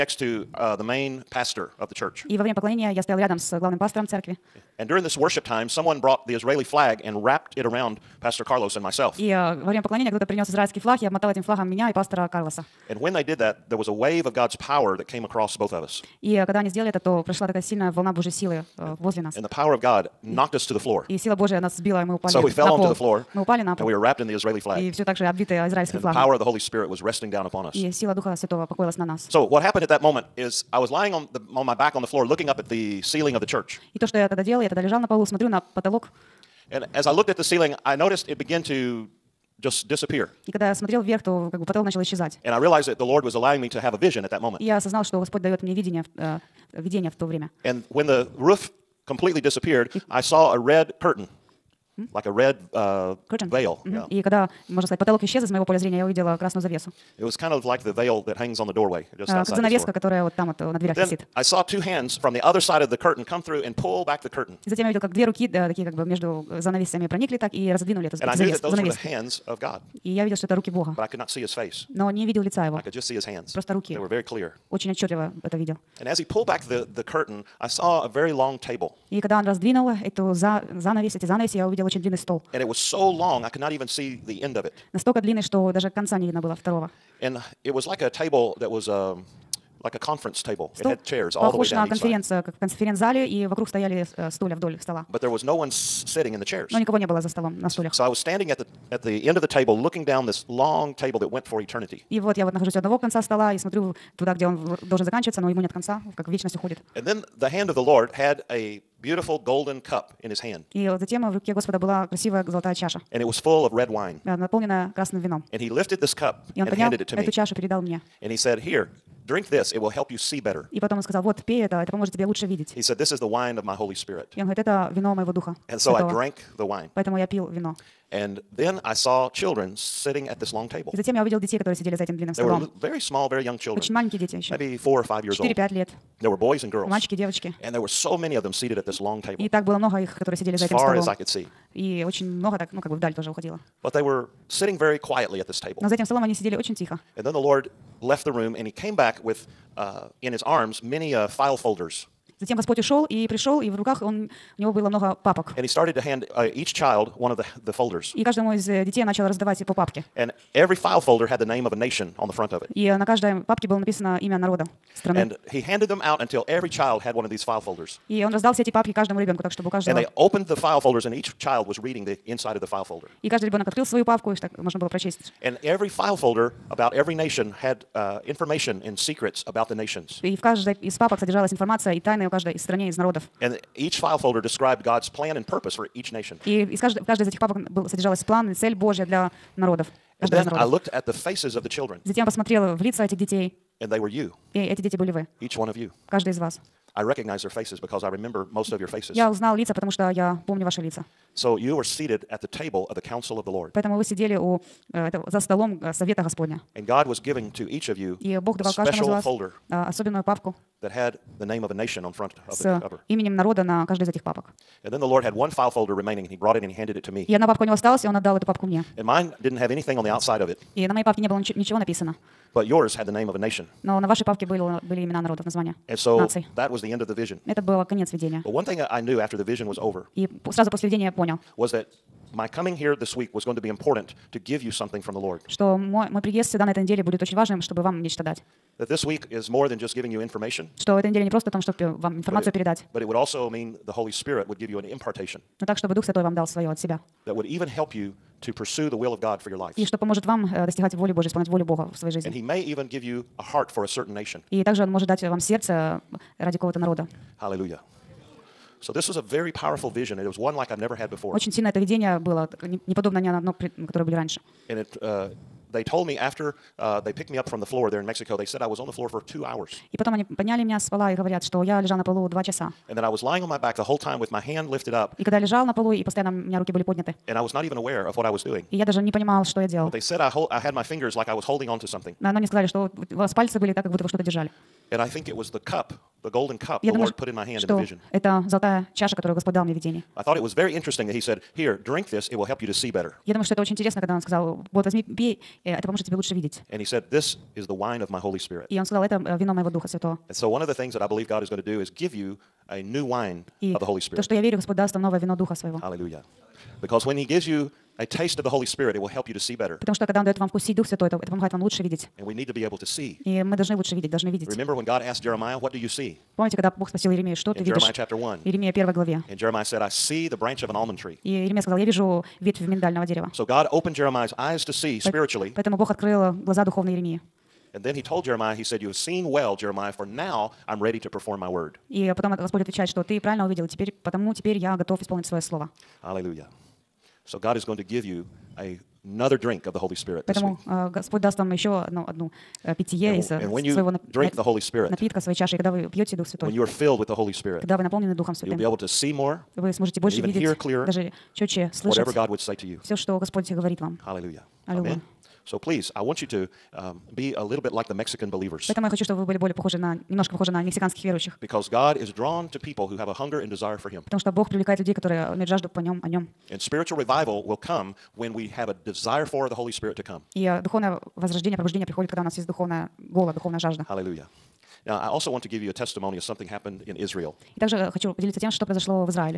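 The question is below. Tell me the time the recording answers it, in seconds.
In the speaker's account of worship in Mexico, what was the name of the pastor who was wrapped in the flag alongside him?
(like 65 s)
8 s.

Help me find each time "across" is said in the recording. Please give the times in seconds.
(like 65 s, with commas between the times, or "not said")
15 s.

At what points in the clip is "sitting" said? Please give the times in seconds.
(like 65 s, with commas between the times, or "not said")
95 s, 129 s, 144 s.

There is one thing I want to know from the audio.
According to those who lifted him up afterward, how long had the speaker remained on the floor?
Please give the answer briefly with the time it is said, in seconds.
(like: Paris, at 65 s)
2 hours, at 269 s.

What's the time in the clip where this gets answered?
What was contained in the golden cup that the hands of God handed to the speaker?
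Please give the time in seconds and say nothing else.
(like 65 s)
113 s.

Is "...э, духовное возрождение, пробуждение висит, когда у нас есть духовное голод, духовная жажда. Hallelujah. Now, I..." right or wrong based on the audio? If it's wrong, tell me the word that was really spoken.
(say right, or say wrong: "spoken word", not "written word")
wrong: "приходит", not "висит".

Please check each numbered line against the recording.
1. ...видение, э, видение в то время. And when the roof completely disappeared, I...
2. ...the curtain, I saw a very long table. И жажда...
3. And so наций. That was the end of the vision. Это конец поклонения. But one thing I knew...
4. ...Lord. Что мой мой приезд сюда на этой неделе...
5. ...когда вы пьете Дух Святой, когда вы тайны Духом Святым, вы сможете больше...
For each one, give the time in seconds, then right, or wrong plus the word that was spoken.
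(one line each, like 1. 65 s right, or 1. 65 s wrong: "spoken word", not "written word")
1. 45 s right
2. 76 s wrong: "когда", not "жажда"
3. 225 s wrong: "видения", not "поклонения"
4. 235 s right
5. 345 s wrong: "наполнены", not "тайны".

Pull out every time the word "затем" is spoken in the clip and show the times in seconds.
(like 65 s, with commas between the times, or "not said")
64 s, 110 s, 130 s, 152 s, 192 s.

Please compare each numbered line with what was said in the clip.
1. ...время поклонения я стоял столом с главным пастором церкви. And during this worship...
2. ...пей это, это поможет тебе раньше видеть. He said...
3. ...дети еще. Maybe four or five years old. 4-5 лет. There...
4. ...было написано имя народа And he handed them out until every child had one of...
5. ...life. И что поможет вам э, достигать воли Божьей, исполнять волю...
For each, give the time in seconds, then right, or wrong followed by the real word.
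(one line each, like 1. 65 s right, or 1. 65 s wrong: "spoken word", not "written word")
1. 2 s wrong: "рядом", not "столом"
2. 121 s wrong: "лучше", not "раньше"
3. 134 s right
4. 163 s right
5. 249 s right.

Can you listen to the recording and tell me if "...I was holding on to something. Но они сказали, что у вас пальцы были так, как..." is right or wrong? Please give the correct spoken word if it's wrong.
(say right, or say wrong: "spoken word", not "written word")
right.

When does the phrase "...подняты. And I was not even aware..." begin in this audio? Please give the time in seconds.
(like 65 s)
276 s.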